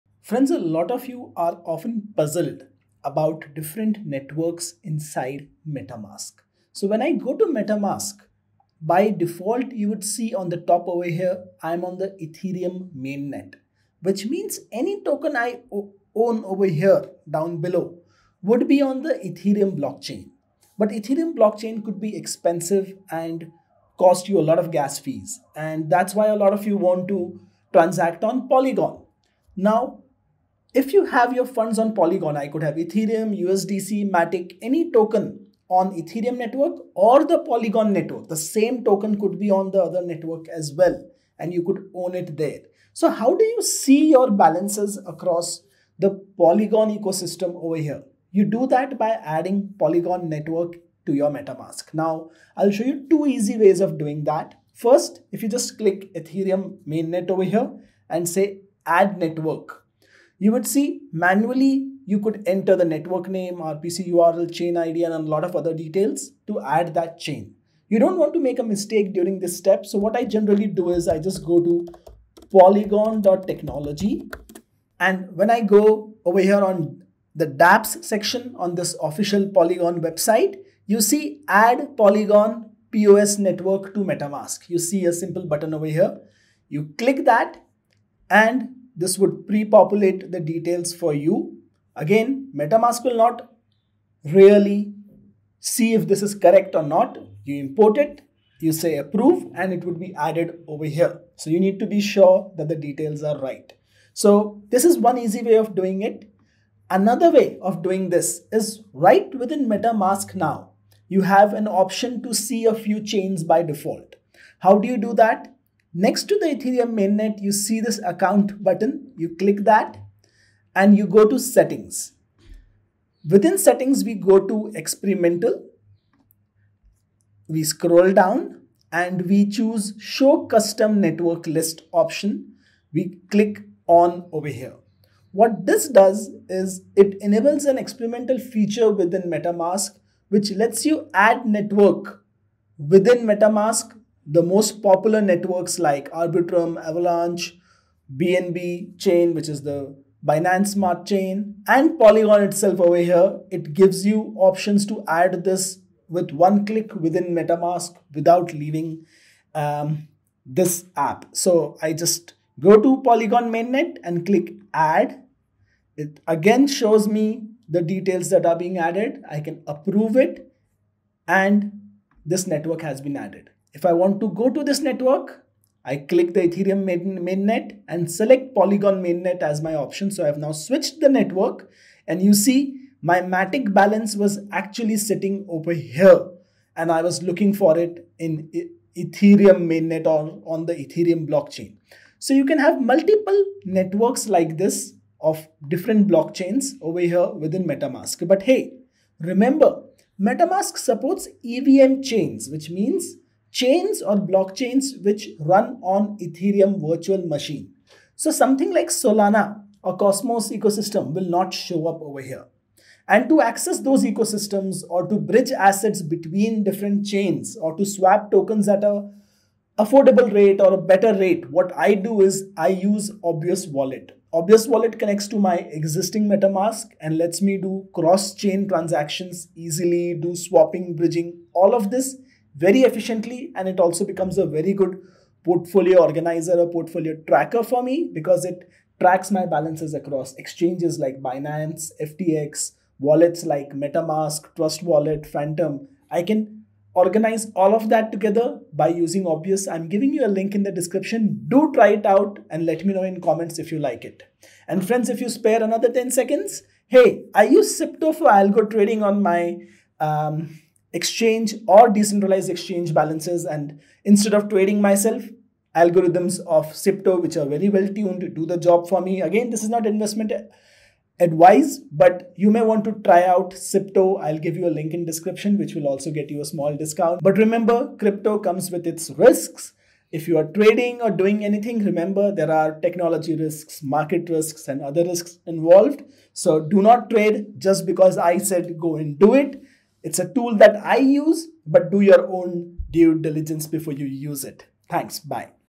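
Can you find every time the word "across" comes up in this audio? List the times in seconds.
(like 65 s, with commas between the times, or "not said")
45 s, 239 s.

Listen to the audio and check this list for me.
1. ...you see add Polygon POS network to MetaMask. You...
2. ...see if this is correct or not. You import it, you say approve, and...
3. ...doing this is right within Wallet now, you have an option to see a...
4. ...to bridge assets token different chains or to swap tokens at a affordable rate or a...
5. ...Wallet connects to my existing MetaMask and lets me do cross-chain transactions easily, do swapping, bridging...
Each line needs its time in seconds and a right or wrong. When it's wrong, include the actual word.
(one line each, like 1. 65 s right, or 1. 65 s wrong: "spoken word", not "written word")
1. 80 s right
2. 95 s right
3. 107 s wrong: "MetaMask", not "Wallet"
4. 215 s wrong: "between", not "token"
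5. 224 s right.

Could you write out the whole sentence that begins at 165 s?
It again shows me the details that are being added.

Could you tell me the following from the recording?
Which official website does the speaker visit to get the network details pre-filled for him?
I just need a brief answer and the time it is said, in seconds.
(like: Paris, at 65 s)
polygon.technology, at 72 s.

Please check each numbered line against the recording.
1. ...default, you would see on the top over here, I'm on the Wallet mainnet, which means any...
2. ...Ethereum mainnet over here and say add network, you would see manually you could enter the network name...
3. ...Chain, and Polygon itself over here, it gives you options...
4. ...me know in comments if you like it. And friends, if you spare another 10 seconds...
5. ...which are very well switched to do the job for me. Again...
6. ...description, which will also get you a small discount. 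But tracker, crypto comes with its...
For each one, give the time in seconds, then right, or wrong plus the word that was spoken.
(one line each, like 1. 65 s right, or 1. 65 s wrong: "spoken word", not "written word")
1. 9 s wrong: "Ethereum", not "Wallet"
2. 56 s right
3. 151 s right
4. 252 s right
5. 267 s wrong: "tuned", not "switched"
6. 275 s wrong: "remember", not "tracker".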